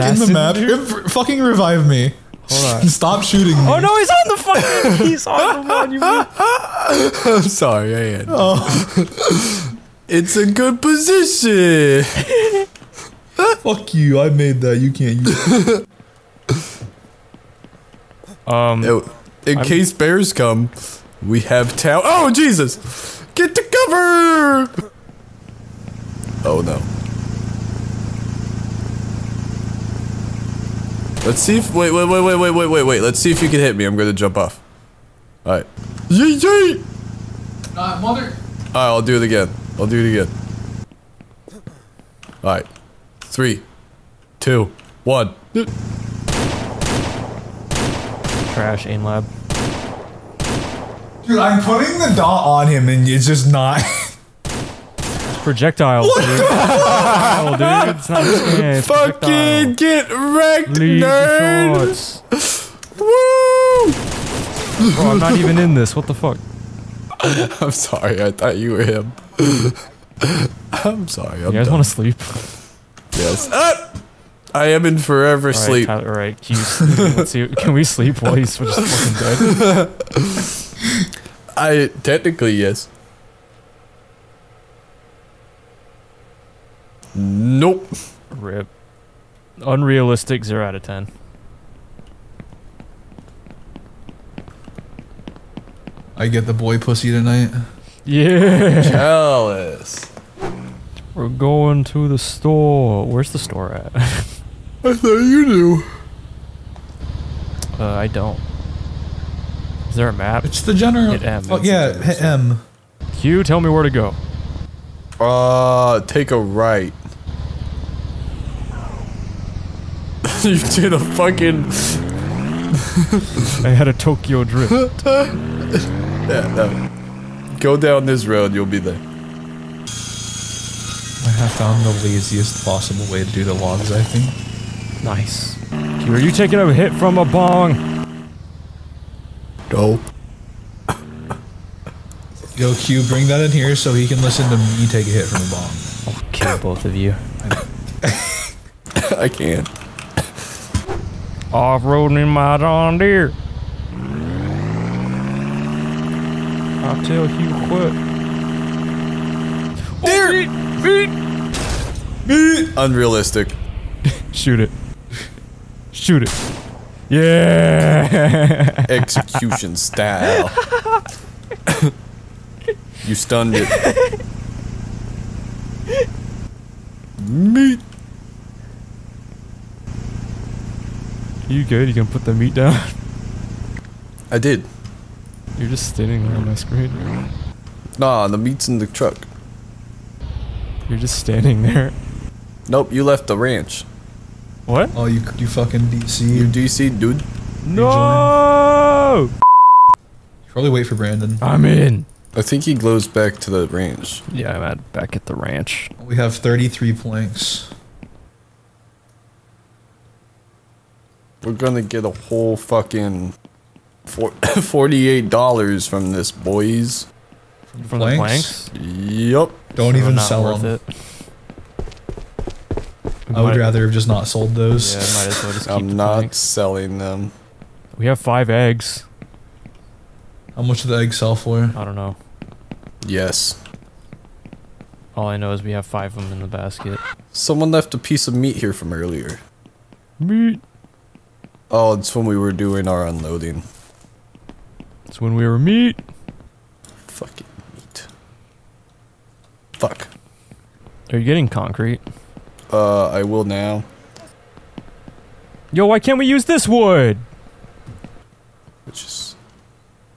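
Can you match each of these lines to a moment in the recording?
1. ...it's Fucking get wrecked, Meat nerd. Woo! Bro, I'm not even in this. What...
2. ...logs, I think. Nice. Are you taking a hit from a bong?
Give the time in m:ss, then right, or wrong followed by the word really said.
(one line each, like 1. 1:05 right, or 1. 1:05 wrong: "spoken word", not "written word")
1. 0:58 wrong: "Leave", not "Meat"
2. 2:13 right.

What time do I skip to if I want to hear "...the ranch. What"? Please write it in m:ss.
3:13.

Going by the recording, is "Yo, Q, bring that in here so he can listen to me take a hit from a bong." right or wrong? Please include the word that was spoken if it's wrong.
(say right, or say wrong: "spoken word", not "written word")
right.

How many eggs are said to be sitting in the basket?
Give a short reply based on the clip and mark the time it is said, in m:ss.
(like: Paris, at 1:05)
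5, at 3:48.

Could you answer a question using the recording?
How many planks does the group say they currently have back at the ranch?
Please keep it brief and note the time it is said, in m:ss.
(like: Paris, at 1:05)
33, at 3:26.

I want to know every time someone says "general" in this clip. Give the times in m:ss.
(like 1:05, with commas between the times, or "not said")
1:50.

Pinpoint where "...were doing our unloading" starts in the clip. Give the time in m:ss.
4:02.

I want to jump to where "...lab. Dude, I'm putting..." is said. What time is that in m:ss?
0:49.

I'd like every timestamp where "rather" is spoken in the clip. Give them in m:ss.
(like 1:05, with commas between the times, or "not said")
3:43.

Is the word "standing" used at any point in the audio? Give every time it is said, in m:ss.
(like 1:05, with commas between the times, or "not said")
3:05, 3:11.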